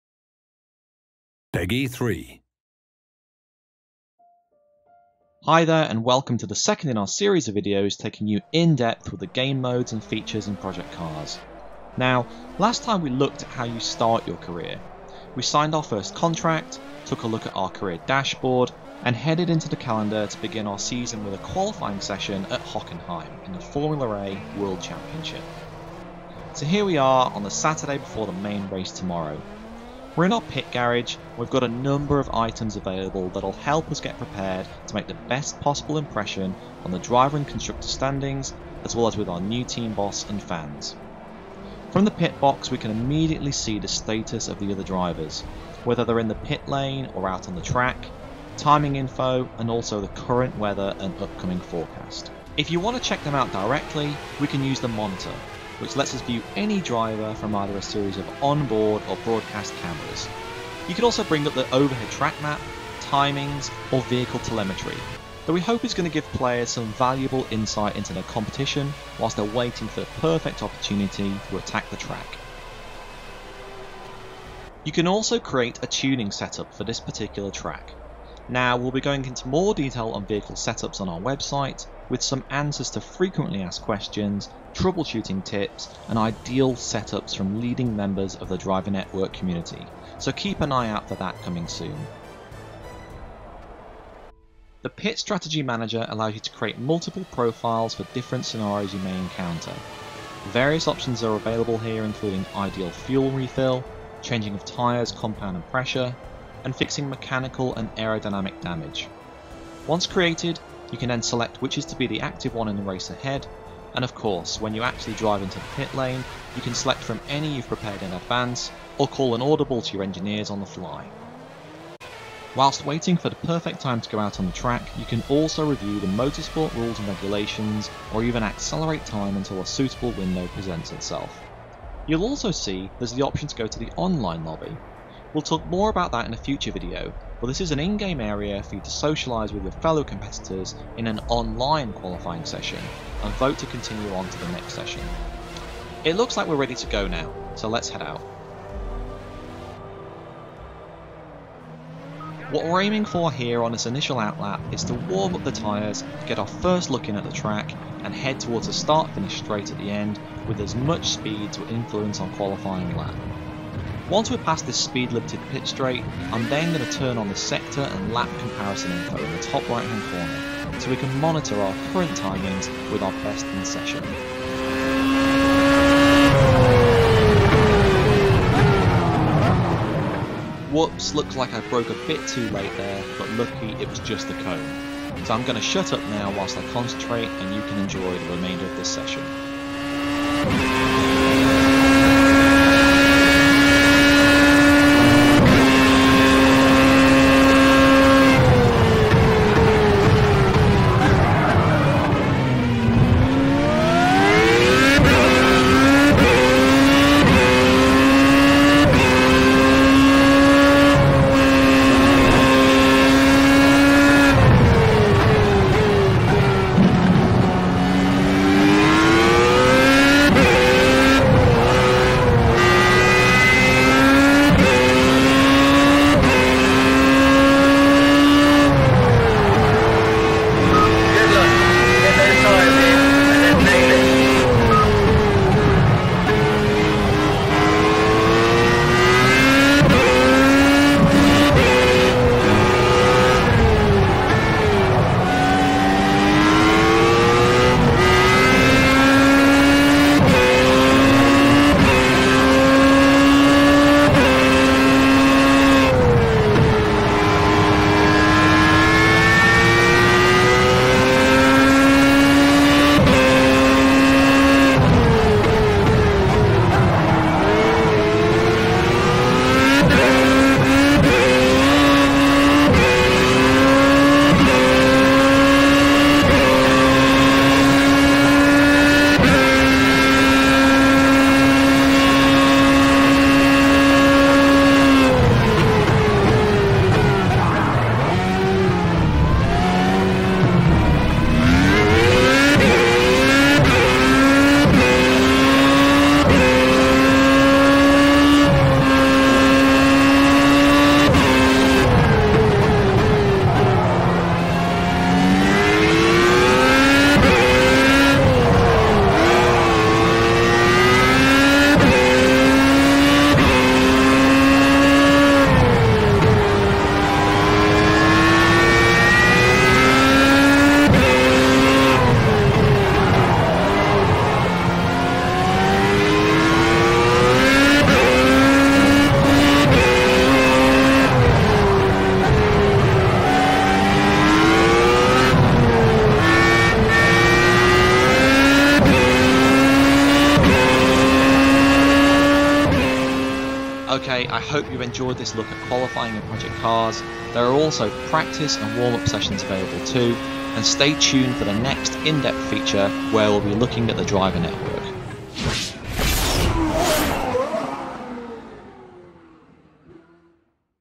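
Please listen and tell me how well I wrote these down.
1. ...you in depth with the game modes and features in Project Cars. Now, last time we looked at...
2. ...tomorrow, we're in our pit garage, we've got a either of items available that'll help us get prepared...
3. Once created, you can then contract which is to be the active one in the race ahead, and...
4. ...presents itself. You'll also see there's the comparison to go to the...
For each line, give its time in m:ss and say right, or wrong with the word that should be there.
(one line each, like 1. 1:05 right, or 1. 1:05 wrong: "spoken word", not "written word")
1. 0:08 right
2. 0:28 wrong: "number", not "either"
3. 1:49 wrong: "select", not "contract"
4. 2:10 wrong: "option", not "comparison".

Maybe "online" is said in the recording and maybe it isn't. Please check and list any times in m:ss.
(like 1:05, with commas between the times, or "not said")
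2:13, 2:21.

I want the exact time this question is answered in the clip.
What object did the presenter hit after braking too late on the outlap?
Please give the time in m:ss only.
3:04.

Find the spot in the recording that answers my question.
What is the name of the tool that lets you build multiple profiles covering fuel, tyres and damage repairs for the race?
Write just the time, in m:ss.
1:34.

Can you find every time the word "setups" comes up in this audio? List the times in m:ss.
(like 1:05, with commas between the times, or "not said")
1:16, 1:20, 1:26.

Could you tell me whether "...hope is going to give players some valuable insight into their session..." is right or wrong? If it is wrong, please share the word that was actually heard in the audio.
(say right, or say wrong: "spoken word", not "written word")
wrong: "competition", not "session".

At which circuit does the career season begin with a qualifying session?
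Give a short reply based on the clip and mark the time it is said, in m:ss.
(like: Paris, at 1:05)
Hockenheim, at 0:22.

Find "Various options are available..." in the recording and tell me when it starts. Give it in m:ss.
1:40.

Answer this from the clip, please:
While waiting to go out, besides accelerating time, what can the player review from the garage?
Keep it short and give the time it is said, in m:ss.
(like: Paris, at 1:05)
motorsport rules and regulations, at 2:06.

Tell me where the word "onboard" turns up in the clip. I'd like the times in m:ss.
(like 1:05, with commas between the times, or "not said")
0:58.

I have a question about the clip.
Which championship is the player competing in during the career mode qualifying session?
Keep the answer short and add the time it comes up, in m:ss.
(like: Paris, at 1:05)
Formula A World Championship, at 0:23.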